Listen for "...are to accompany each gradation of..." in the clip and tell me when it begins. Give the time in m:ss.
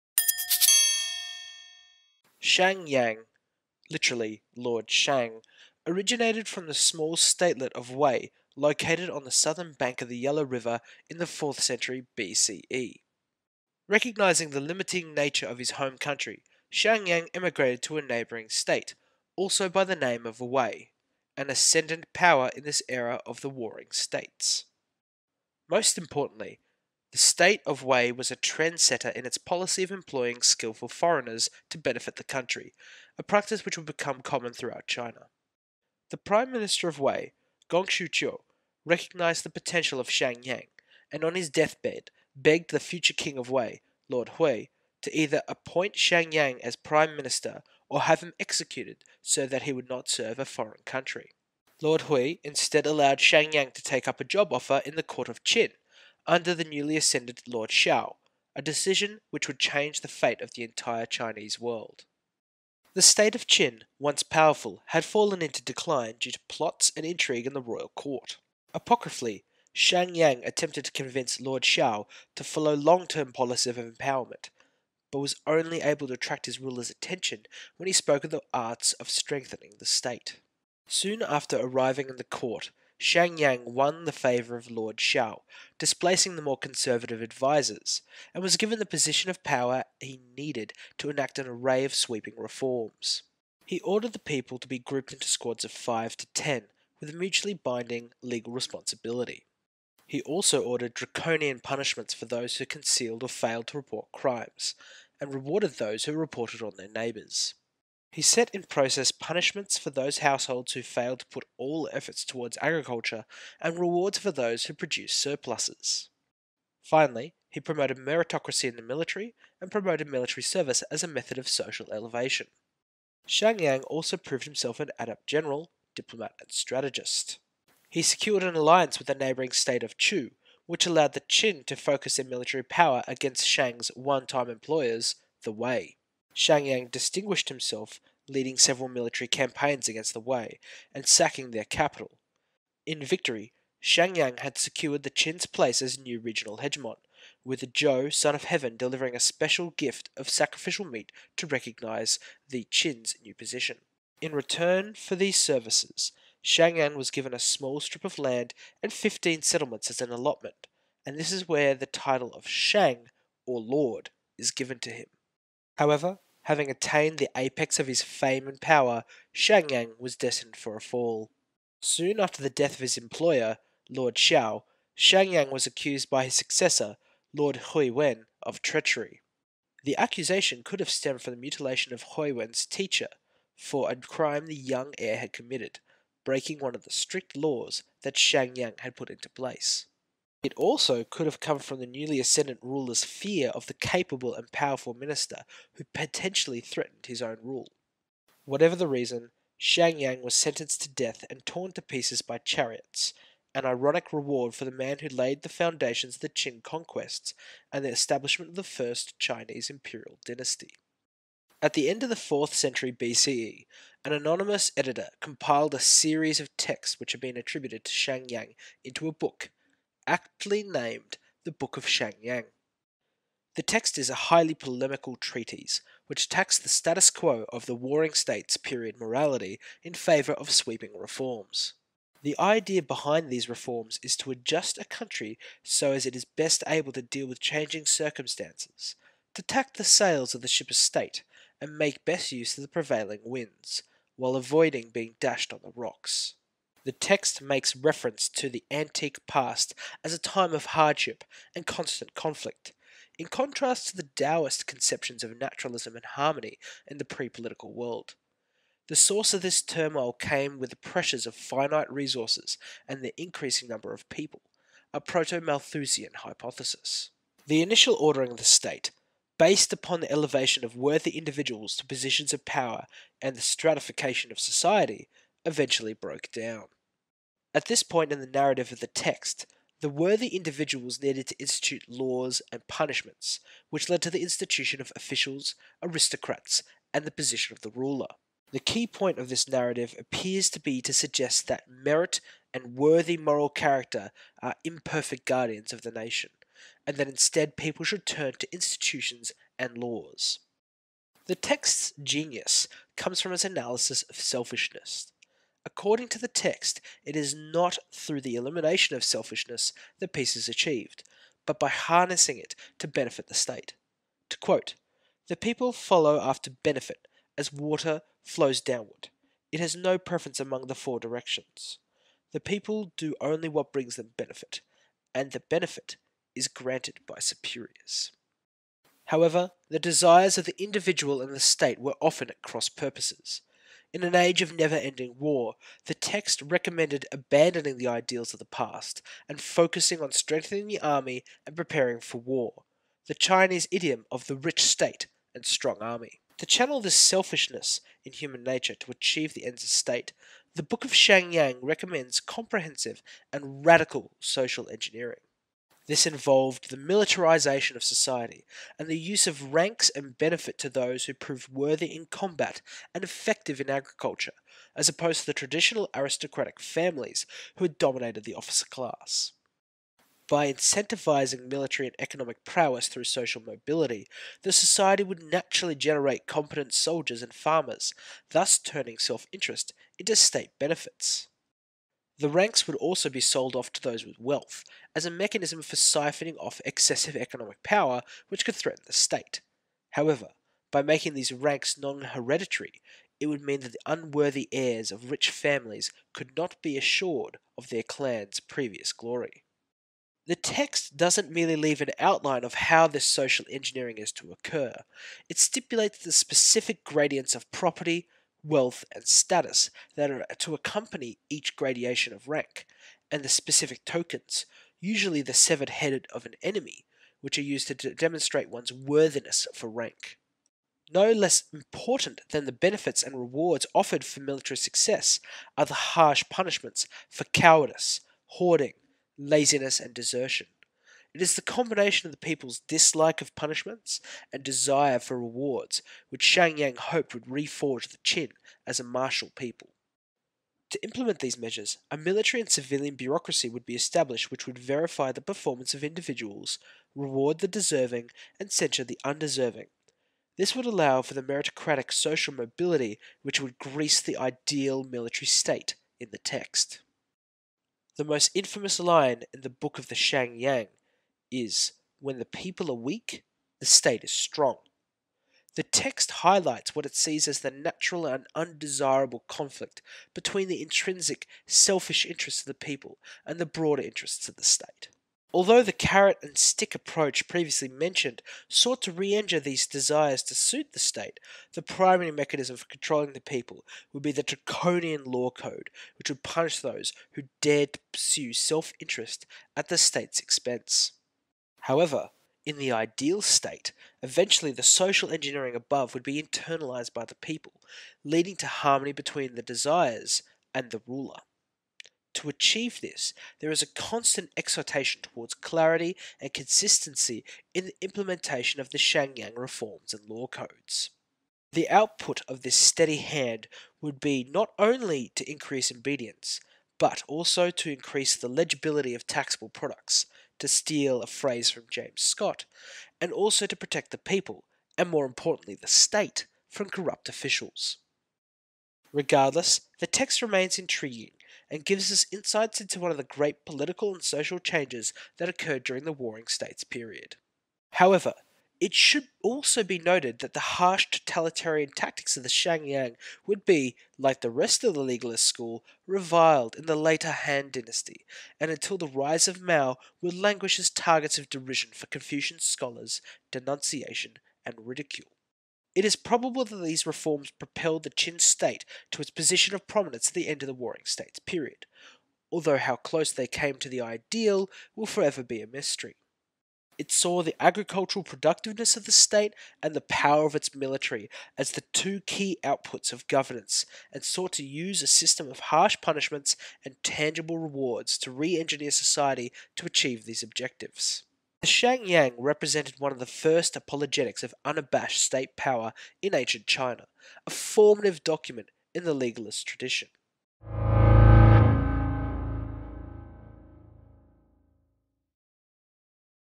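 6:50.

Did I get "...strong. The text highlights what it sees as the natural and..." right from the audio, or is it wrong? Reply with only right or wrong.
right.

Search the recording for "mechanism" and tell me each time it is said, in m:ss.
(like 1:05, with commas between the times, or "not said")
6:25, 8:02.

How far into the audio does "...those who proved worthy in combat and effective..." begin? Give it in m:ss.
6:00.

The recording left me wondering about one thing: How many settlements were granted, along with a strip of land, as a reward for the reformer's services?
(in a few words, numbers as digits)
15.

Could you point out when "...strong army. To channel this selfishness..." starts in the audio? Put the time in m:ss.
5:45.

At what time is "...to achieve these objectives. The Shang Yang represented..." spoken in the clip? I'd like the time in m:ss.
9:39.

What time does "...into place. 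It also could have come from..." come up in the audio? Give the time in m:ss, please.
3:09.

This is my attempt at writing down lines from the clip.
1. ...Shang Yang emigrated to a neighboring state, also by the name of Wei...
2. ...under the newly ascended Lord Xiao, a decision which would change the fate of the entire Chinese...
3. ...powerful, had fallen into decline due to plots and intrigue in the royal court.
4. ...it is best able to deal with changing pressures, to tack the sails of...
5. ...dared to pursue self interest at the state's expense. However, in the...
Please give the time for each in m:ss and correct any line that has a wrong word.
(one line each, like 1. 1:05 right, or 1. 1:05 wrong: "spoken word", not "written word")
1. 0:16 right
2. 0:56 right
3. 1:04 right
4. 3:56 wrong: "circumstances", not "pressures"
5. 8:07 right.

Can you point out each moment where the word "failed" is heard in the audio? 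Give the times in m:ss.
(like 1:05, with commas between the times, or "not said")
1:43, 1:50.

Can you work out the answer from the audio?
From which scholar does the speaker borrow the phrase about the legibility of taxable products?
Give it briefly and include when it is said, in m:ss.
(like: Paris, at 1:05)
James Scott, at 8:41.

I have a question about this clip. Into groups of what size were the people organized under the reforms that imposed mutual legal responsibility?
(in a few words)
5 to 10.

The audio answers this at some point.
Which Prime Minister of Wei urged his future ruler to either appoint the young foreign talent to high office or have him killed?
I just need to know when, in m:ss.
0:37.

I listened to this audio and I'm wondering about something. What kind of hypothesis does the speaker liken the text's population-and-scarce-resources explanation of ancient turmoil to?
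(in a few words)
proto Malthusian.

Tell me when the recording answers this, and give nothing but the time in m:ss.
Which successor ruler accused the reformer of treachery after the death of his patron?
2:57.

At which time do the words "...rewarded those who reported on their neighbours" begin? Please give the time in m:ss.
1:45.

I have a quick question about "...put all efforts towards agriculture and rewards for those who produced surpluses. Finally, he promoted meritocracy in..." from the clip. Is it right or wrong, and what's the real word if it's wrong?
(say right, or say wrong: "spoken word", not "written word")
right.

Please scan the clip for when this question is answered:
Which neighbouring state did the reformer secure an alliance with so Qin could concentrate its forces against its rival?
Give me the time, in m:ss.
2:09.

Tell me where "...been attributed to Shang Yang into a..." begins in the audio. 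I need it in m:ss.
3:37.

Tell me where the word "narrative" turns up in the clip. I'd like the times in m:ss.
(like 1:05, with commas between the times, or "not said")
4:38, 4:49.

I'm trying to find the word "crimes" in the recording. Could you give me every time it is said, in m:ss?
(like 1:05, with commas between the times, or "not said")
1:44, 3:03.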